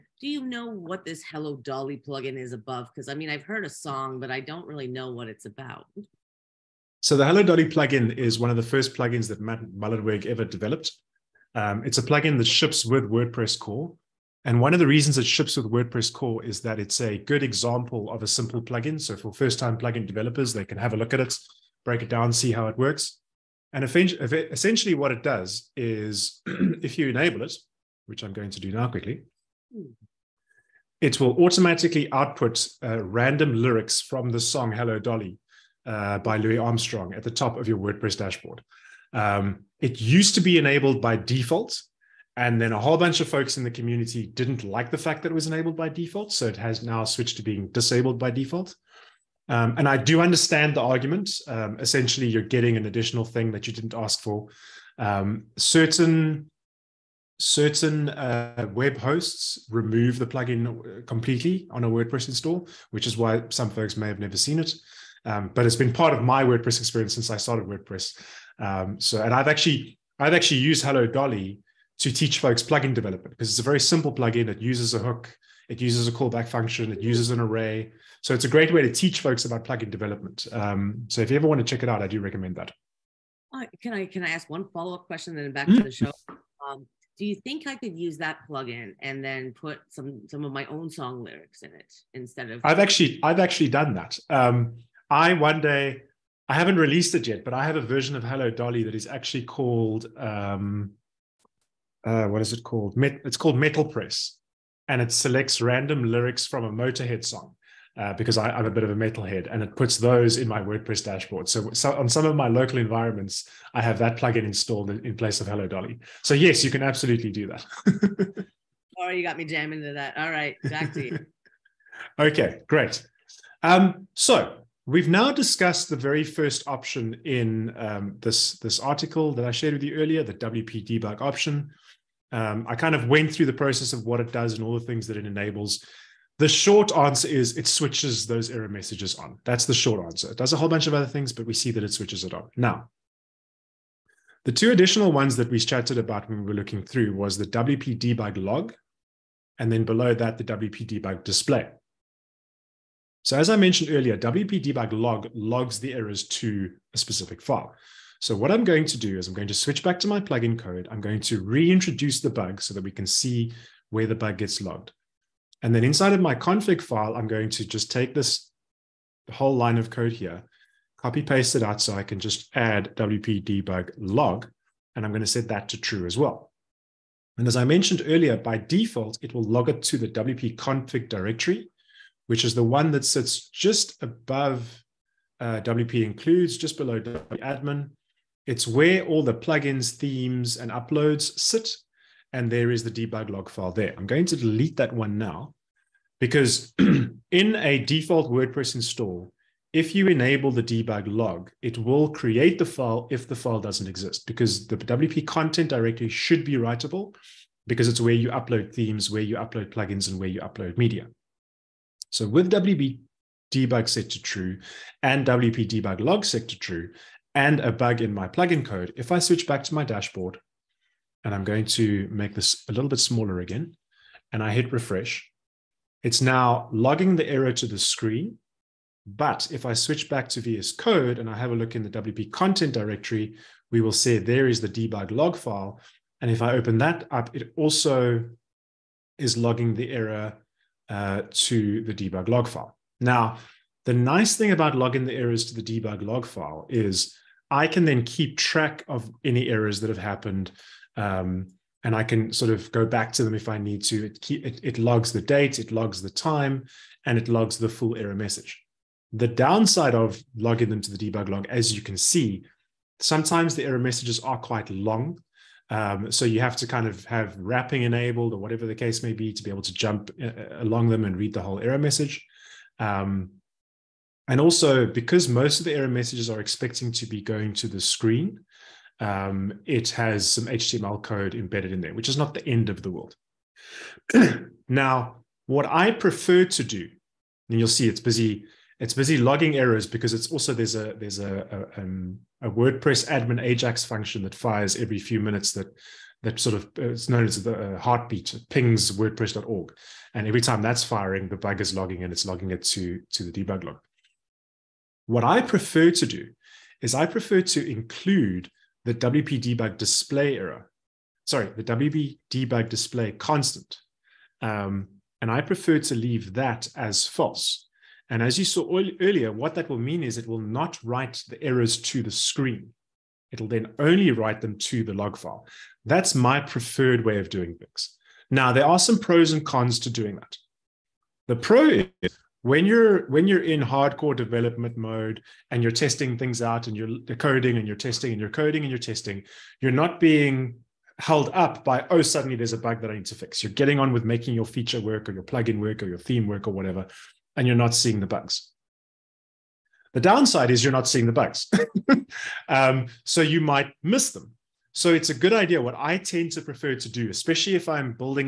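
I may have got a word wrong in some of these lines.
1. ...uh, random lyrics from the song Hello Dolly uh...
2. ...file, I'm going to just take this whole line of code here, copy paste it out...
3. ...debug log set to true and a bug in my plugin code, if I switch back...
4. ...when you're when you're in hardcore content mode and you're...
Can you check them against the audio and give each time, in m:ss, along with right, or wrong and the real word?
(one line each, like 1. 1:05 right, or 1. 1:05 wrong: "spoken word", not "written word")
1. 0:32 right
2. 2:46 right
3. 3:35 right
4. 5:32 wrong: "development", not "content".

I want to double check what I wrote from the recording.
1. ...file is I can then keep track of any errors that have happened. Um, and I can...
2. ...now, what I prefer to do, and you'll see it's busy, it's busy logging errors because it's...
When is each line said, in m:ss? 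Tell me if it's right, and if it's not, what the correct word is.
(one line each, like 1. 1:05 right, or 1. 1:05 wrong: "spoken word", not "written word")
1. 4:06 right
2. 4:44 right.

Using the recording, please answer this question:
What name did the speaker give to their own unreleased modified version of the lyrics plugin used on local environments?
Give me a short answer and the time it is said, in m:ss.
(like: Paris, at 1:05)
Metal Press, at 1:43.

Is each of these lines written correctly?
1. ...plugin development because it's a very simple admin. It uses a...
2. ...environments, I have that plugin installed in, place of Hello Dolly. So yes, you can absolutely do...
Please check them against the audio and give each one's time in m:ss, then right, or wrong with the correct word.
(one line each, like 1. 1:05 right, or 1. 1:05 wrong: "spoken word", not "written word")
1. 1:12 wrong: "plugin", not "admin"
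2. 1:52 right.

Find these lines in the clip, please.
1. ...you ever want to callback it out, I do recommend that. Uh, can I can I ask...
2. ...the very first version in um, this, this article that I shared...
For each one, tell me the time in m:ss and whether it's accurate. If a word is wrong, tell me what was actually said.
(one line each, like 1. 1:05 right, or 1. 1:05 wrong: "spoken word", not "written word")
1. 1:21 wrong: "check", not "callback"
2. 2:05 wrong: "option", not "version".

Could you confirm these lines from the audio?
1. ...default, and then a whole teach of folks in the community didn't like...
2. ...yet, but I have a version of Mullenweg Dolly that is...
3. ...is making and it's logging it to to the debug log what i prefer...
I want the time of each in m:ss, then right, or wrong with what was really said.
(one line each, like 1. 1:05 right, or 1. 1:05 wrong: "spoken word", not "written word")
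1. 0:41 wrong: "bunch", not "teach"
2. 1:37 wrong: "Hello", not "Mullenweg"
3. 5:01 wrong: "logging", not "making".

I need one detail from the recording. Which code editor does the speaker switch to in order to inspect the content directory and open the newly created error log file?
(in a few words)
VS Code.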